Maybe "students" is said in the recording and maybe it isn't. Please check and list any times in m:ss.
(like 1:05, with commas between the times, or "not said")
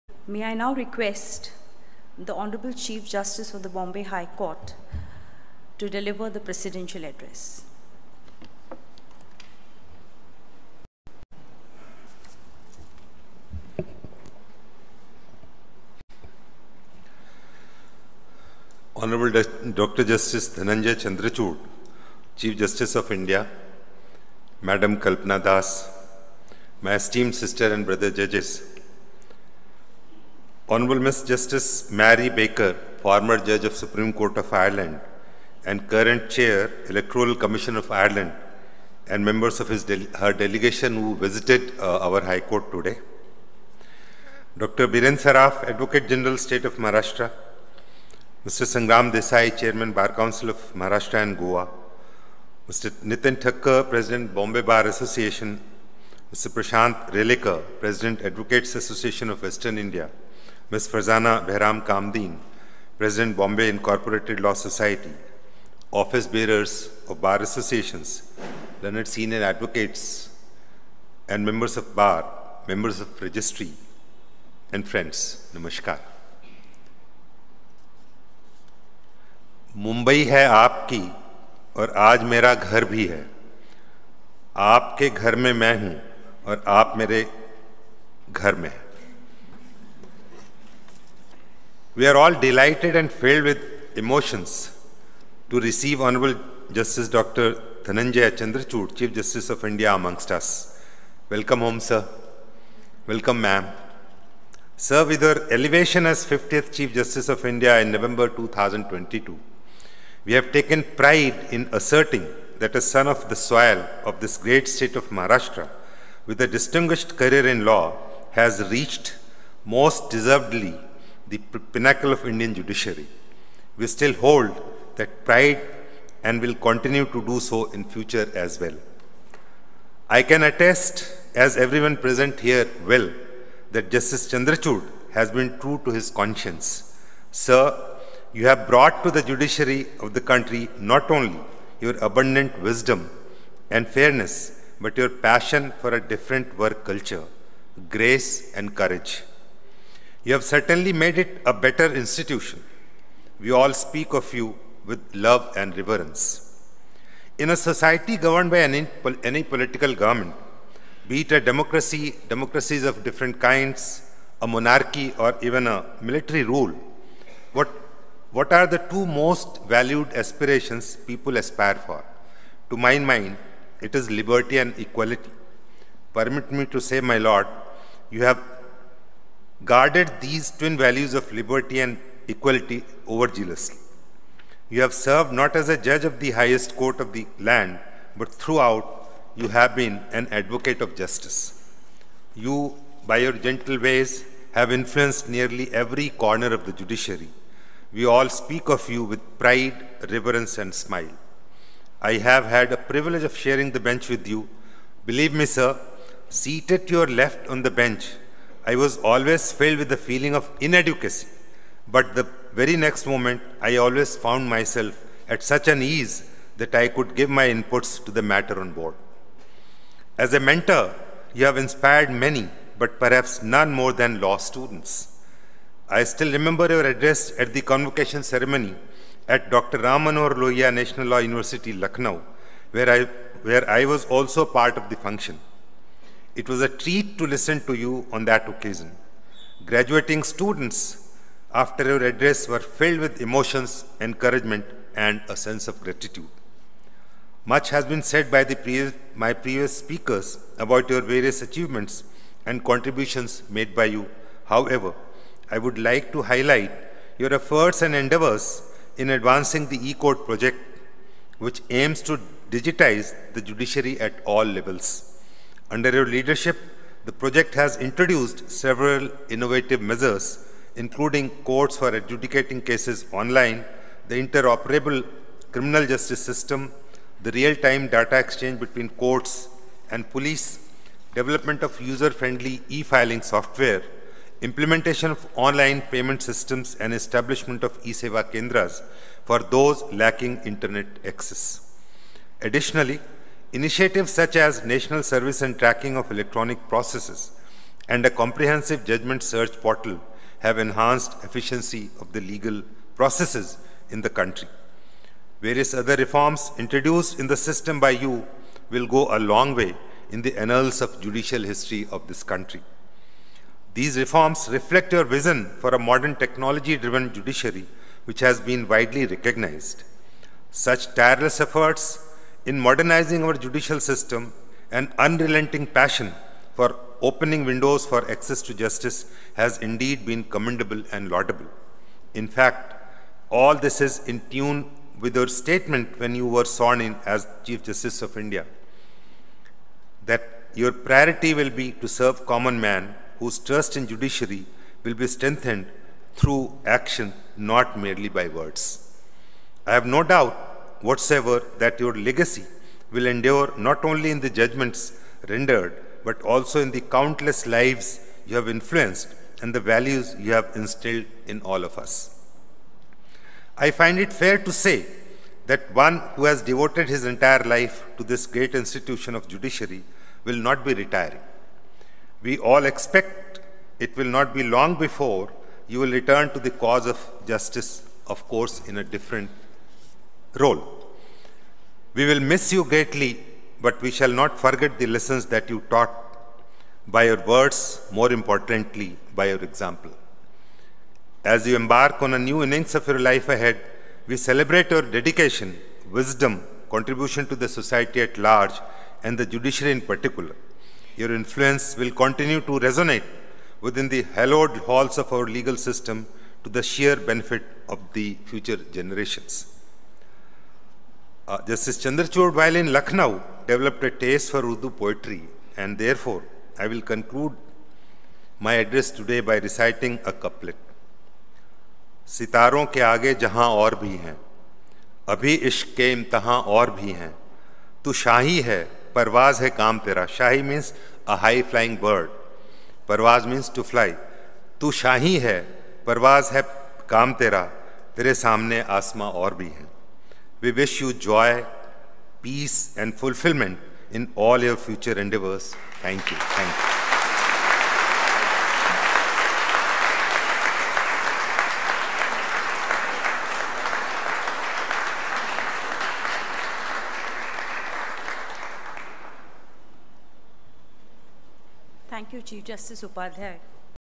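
3:44, 4:00.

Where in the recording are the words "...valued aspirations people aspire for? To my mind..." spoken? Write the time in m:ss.
2:49.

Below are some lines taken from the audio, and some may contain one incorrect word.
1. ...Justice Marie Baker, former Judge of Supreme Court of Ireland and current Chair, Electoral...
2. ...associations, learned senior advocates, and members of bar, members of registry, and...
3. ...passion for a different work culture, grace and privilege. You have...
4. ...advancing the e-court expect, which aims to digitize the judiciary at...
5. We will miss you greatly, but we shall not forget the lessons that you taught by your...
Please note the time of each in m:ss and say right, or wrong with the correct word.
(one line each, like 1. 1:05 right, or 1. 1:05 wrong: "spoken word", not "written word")
1. 0:31 right
2. 1:07 right
3. 2:25 wrong: "courage", not "privilege"
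4. 4:19 wrong: "project", not "expect"
5. 6:21 right.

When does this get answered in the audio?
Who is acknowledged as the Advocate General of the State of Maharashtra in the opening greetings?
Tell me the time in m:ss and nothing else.
0:44.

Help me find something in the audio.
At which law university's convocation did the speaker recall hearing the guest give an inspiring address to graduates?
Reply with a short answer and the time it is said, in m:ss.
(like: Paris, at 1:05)
Dr. Ram Manohar Lohia National Law University, at 3:49.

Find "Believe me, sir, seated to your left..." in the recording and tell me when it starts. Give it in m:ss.
3:25.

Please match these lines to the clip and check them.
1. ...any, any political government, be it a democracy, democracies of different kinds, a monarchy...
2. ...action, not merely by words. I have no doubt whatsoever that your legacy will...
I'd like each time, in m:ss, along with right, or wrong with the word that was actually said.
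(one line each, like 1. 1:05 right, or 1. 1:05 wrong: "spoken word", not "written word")
1. 2:38 right
2. 5:46 right.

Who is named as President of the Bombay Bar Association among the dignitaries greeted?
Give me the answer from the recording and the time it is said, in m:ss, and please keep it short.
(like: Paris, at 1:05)
Nitin Thakkar, at 0:53.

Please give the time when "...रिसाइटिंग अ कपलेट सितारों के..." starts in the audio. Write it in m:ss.
6:59.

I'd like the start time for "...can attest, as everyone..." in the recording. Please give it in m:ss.
2:10.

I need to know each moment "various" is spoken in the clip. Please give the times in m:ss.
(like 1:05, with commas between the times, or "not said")
4:11, 5:05.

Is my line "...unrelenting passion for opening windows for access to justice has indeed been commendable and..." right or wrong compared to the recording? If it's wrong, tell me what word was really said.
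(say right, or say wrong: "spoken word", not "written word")
right.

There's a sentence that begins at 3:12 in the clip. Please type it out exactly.
You, by your gentle ways, have influenced nearly every corner of the judiciary.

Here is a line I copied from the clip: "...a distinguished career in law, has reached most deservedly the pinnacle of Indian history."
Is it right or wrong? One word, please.
wrong.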